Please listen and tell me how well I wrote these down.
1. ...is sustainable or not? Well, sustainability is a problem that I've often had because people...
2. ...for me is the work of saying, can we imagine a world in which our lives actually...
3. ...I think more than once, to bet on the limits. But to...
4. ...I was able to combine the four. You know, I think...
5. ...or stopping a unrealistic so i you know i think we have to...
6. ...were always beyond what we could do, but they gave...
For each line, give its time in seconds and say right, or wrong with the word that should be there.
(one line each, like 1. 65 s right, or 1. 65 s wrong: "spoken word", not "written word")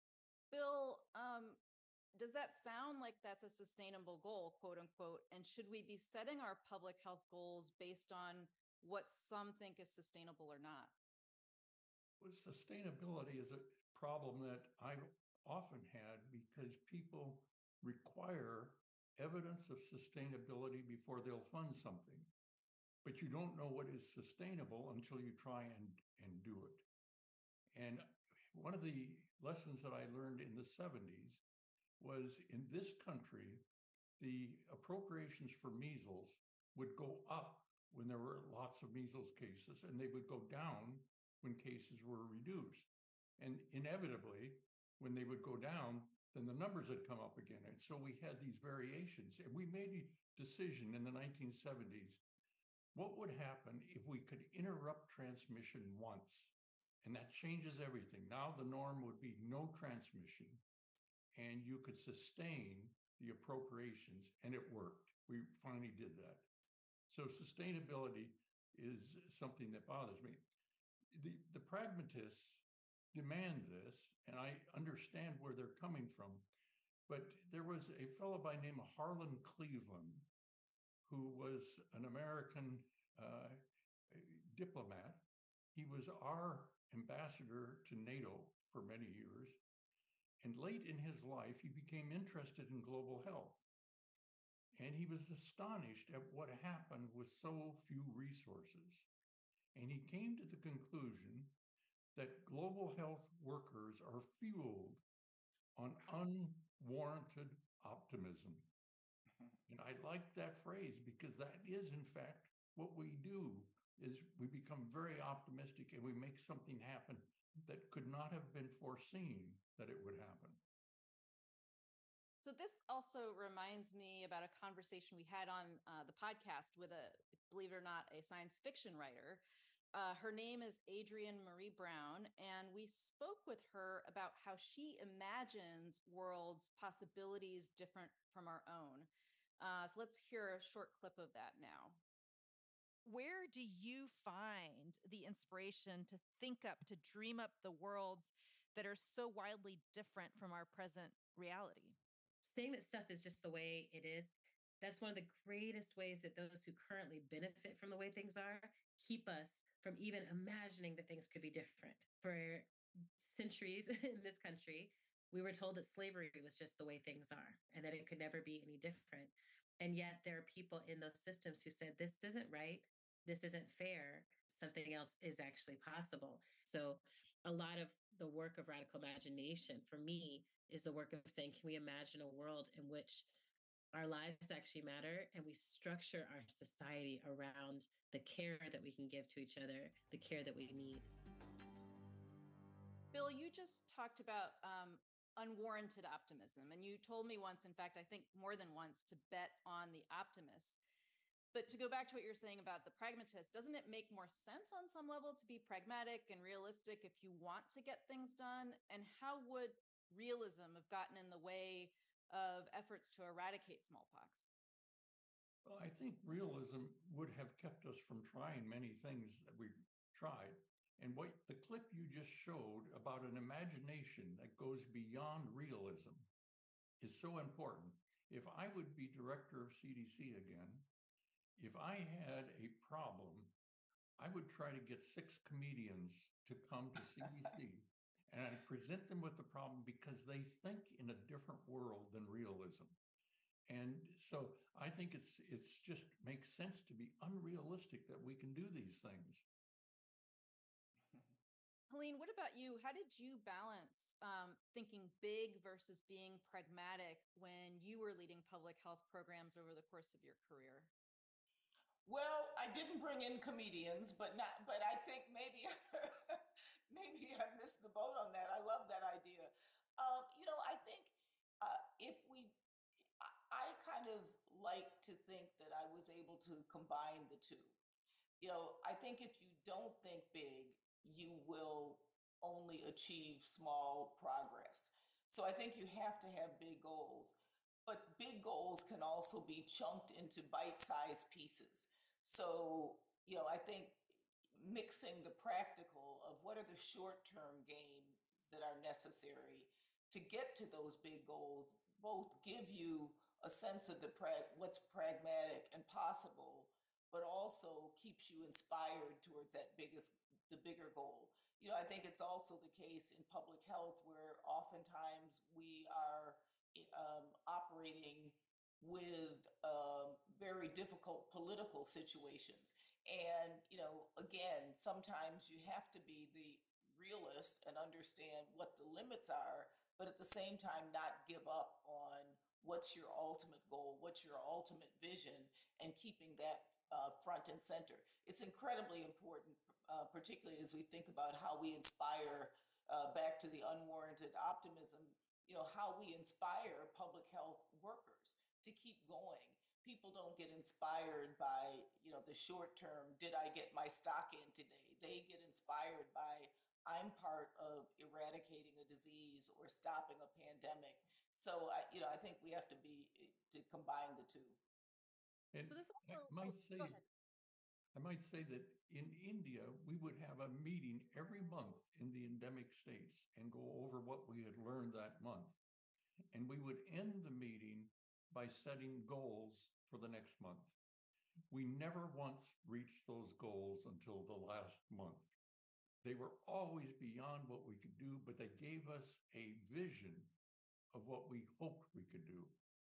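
1. 9 s right
2. 179 s right
3. 197 s wrong: "optimists", not "limits"
4. 275 s wrong: "two", not "four"
5. 359 s wrong: "pandemic", not "unrealistic"
6. 386 s right.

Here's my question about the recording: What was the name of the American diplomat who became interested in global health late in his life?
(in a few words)
Harlan Cleveland.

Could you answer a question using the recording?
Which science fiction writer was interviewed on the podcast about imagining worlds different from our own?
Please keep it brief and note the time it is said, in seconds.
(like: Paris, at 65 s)
Adrienne Maree Brown, at 130 s.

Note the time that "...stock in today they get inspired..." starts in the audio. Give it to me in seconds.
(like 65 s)
353 s.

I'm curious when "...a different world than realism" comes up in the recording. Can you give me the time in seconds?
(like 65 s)
241 s.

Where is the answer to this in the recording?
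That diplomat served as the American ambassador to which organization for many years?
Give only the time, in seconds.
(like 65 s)
87 s.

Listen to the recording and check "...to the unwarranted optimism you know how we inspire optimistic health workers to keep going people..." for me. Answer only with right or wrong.
wrong.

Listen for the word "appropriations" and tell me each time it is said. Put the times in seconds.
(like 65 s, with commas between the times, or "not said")
34 s, 63 s.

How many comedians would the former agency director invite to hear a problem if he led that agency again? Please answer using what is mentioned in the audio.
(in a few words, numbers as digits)
6.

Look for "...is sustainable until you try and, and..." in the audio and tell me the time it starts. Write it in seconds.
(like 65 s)
23 s.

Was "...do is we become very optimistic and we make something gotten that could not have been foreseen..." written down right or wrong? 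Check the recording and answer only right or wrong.
wrong.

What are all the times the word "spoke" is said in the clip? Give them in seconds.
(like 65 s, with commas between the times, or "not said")
132 s.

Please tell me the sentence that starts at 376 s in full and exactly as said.
And we would end the meeting by setting goals for the next month.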